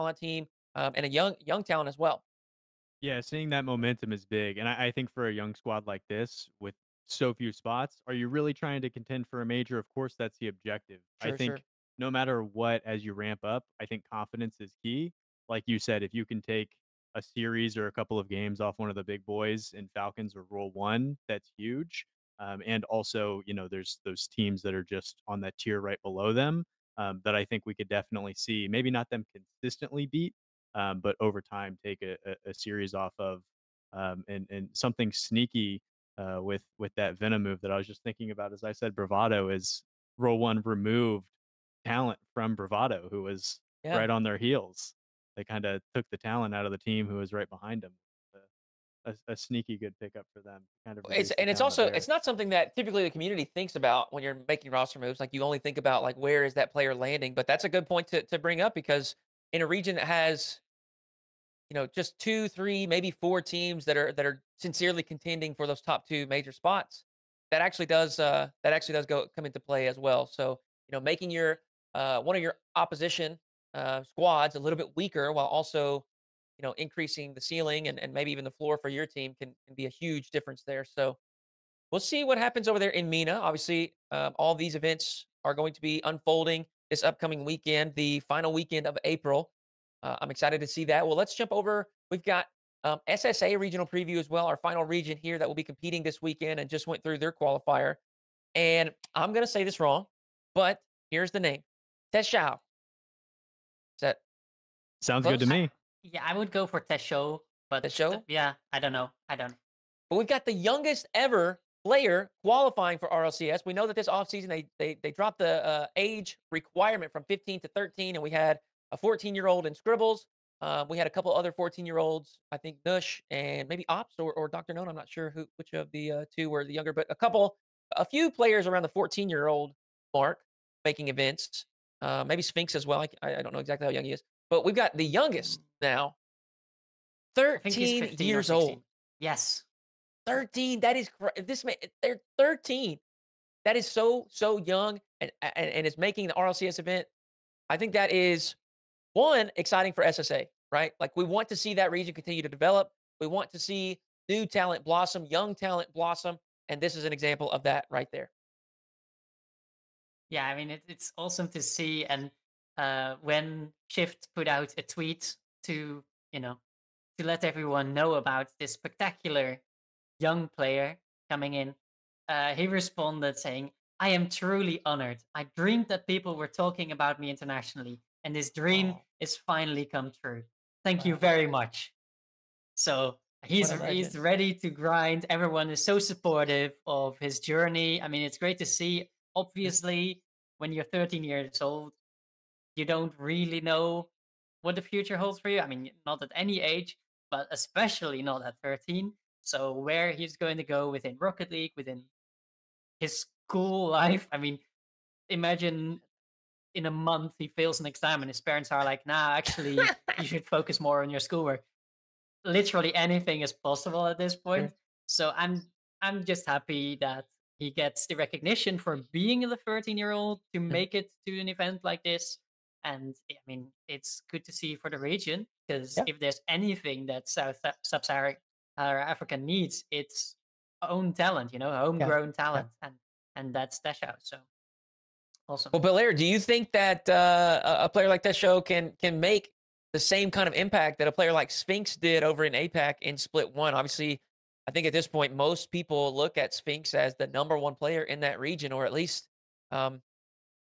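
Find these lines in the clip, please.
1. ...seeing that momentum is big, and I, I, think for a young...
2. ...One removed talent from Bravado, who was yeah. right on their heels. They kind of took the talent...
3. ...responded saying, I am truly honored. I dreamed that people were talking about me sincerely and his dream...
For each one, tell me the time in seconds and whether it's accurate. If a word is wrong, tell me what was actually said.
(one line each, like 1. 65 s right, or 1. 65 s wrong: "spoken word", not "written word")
1. 3 s right
2. 40 s right
3. 172 s wrong: "internationally", not "sincerely".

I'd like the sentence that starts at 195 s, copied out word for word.
I mean, not at any age, but especially not at 13.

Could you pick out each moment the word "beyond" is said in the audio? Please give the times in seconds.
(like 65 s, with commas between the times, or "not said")
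not said.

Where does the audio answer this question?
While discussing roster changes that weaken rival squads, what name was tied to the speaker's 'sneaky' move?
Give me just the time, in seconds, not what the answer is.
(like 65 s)
37 s.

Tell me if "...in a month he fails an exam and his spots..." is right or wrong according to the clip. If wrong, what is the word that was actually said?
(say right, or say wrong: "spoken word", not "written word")
wrong: "parents", not "spots".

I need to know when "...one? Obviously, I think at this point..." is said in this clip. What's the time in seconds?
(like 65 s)
243 s.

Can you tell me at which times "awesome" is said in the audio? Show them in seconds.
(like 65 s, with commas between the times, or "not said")
161 s, 235 s.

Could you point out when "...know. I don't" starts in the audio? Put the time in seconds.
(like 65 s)
108 s.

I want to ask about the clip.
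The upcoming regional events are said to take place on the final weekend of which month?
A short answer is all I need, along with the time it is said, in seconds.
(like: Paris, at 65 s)
April, at 89 s.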